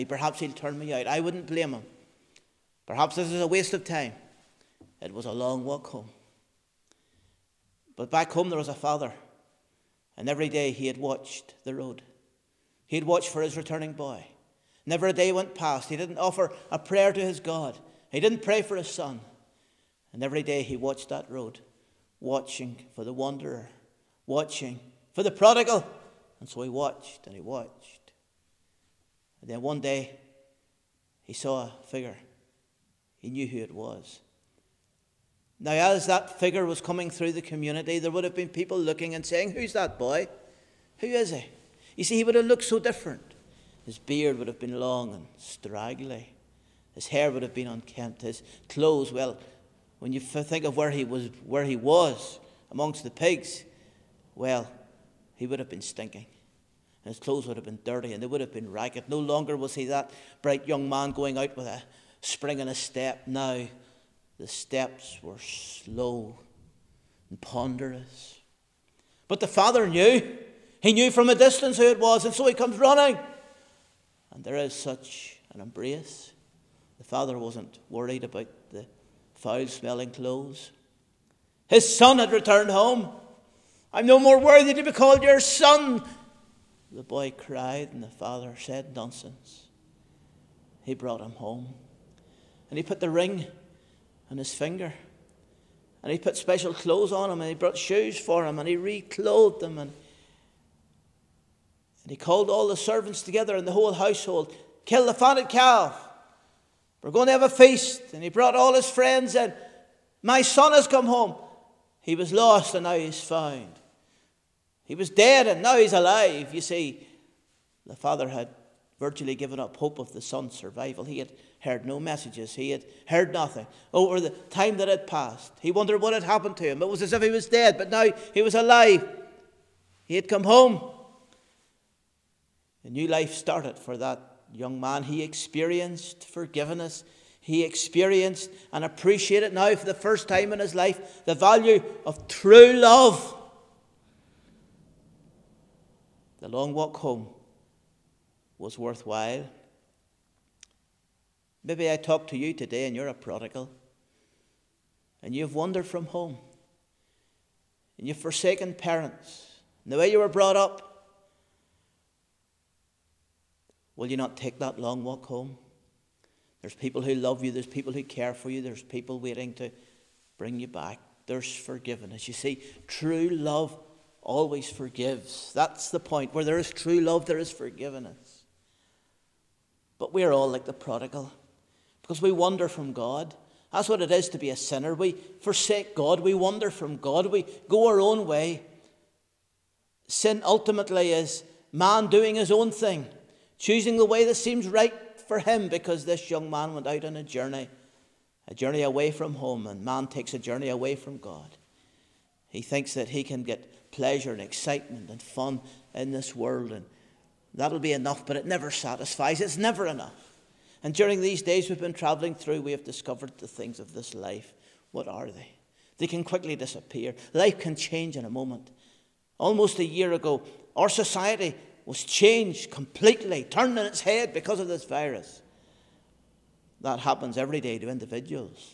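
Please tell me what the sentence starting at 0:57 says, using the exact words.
His clothes would have been dirty and they would have been ragged.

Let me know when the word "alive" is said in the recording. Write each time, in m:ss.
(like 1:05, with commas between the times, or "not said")
1:55, 2:08.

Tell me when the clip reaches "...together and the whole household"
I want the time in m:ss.
1:43.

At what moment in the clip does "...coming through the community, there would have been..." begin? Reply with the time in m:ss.
0:36.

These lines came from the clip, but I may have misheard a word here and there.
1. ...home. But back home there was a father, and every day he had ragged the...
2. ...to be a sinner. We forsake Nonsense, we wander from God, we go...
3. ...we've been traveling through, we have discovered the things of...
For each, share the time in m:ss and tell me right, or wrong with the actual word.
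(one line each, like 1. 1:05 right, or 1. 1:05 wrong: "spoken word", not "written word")
1. 0:05 wrong: "watched", not "ragged"
2. 3:04 wrong: "God", not "Nonsense"
3. 3:31 right.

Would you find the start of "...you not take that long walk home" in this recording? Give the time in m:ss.
2:44.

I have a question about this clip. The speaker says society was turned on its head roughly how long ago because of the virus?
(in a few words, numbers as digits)
almost a year.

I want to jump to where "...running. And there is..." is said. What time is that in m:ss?
1:12.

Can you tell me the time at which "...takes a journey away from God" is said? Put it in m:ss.
3:20.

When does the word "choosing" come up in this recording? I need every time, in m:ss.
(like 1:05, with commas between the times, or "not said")
3:13.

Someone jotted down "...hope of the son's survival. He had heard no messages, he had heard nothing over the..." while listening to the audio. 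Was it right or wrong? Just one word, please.
right.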